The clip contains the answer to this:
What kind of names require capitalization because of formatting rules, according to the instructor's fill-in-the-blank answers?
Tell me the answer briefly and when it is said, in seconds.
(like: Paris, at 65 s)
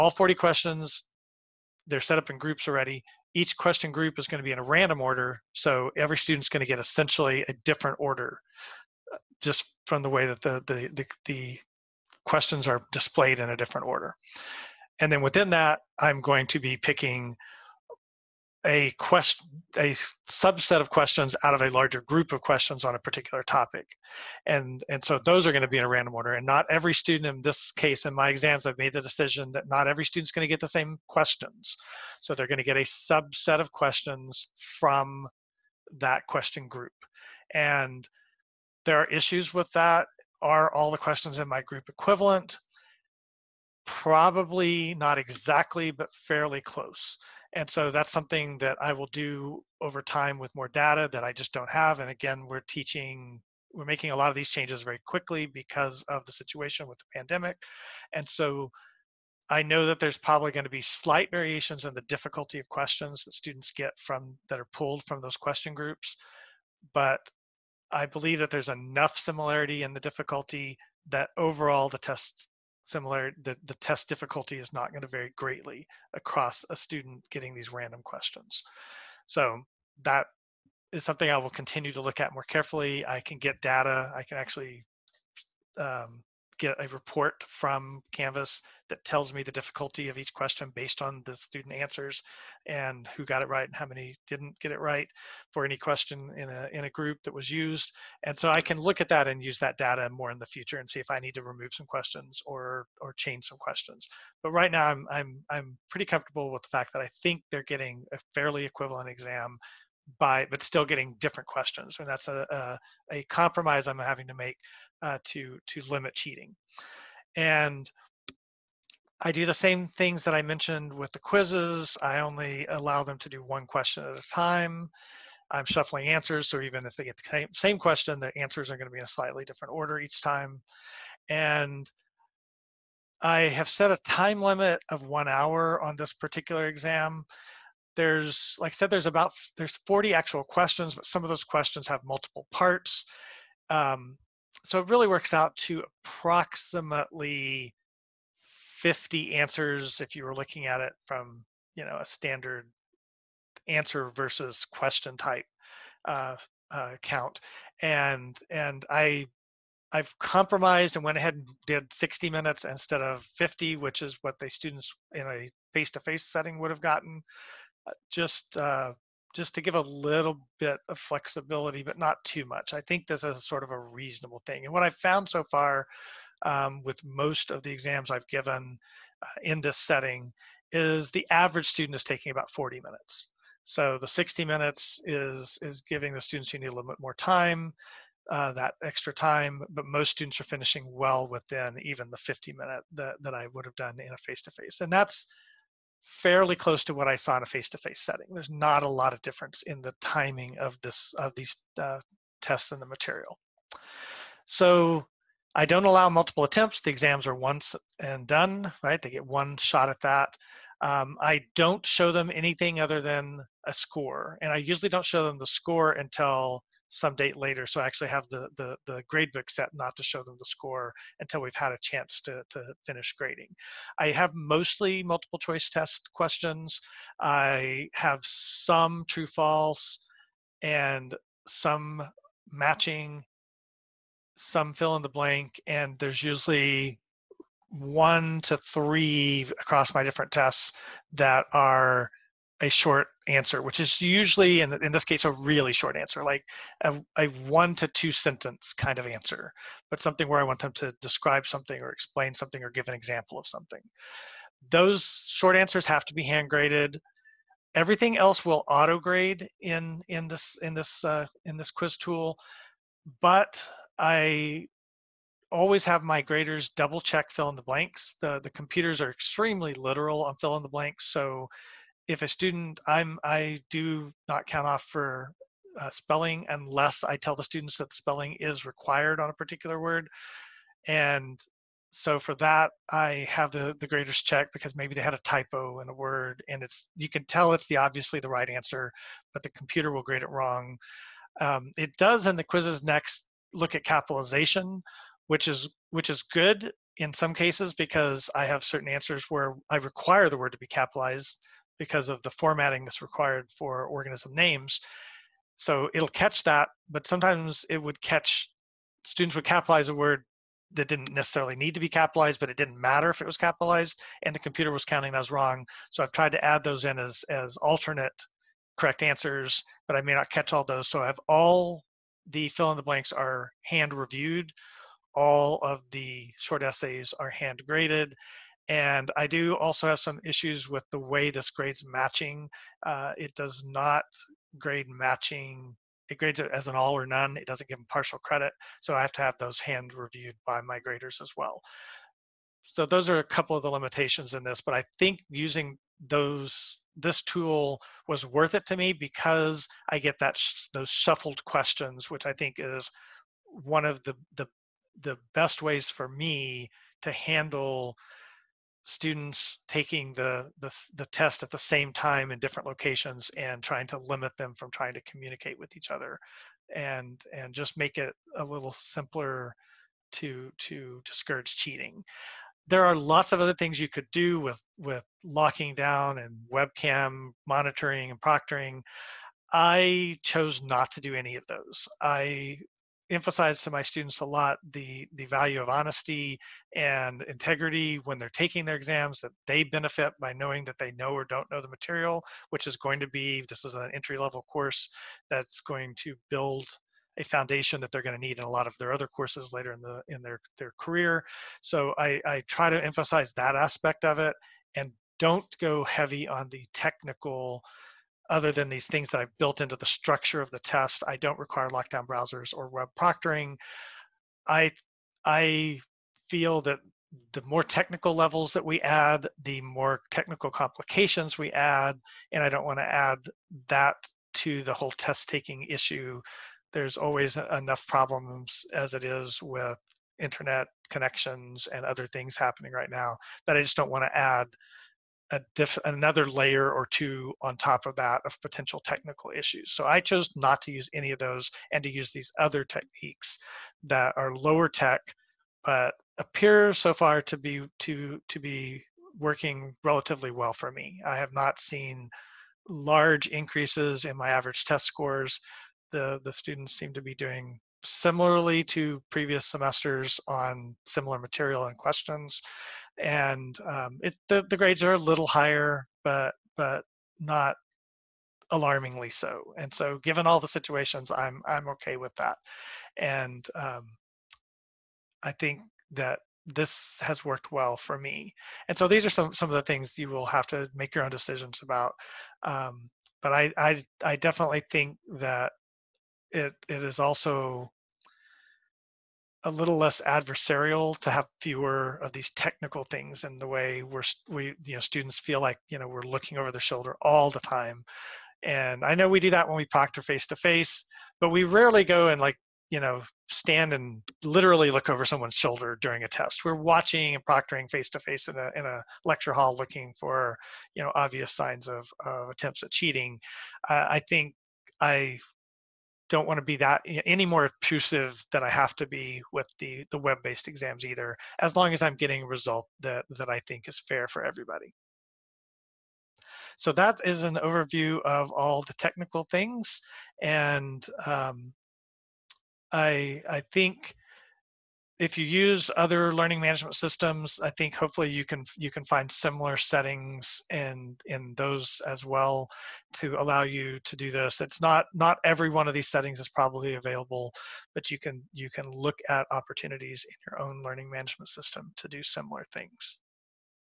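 organism names, at 303 s.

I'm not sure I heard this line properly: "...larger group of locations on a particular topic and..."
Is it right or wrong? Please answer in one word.
wrong.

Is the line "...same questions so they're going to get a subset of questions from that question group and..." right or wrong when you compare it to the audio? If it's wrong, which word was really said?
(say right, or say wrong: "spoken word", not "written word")
right.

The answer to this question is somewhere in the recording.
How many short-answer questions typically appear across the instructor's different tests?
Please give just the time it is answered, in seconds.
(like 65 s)
237 s.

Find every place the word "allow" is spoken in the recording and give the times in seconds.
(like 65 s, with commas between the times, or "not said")
122 s, 205 s, 543 s.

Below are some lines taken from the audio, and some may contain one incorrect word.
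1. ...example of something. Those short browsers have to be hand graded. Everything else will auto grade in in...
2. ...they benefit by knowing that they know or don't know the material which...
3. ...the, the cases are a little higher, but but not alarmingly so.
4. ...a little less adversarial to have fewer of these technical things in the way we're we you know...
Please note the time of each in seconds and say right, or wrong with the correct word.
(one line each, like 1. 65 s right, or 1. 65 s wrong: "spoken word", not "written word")
1. 252 s wrong: "answers", not "browsers"
2. 389 s right
3. 464 s wrong: "grades", not "cases"
4. 489 s right.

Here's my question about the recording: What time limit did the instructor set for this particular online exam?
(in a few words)
one hour.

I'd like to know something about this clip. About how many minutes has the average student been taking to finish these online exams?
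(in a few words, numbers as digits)
40 minutes.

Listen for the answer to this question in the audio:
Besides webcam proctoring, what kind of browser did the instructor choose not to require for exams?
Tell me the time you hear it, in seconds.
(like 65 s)
411 s.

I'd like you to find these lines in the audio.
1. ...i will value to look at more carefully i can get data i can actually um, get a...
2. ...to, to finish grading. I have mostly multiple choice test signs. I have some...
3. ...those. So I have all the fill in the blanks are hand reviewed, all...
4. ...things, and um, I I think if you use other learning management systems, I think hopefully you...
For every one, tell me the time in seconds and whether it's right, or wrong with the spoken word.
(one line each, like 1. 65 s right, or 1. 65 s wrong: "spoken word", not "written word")
1. 81 s wrong: "continue", not "value"
2. 222 s wrong: "questions", not "signs"
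3. 320 s right
4. 529 s right.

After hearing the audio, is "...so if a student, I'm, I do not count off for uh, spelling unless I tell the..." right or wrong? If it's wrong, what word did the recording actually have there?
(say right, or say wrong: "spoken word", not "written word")
right.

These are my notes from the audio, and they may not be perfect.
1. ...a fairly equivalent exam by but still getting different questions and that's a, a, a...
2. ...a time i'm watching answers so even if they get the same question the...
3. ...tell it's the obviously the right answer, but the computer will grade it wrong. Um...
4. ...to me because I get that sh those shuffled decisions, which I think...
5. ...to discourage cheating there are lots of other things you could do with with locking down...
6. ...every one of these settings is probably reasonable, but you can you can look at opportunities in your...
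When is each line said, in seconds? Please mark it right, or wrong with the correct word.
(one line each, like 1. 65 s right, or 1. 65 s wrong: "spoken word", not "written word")
1. 108 s right
2. 124 s wrong: "shuffling", not "watching"
3. 287 s right
4. 348 s wrong: "questions", not "decisions"
5. 370 s right
6. 545 s wrong: "available", not "reasonable".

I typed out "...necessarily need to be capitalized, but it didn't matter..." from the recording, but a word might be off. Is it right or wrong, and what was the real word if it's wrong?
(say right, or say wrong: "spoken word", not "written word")
right.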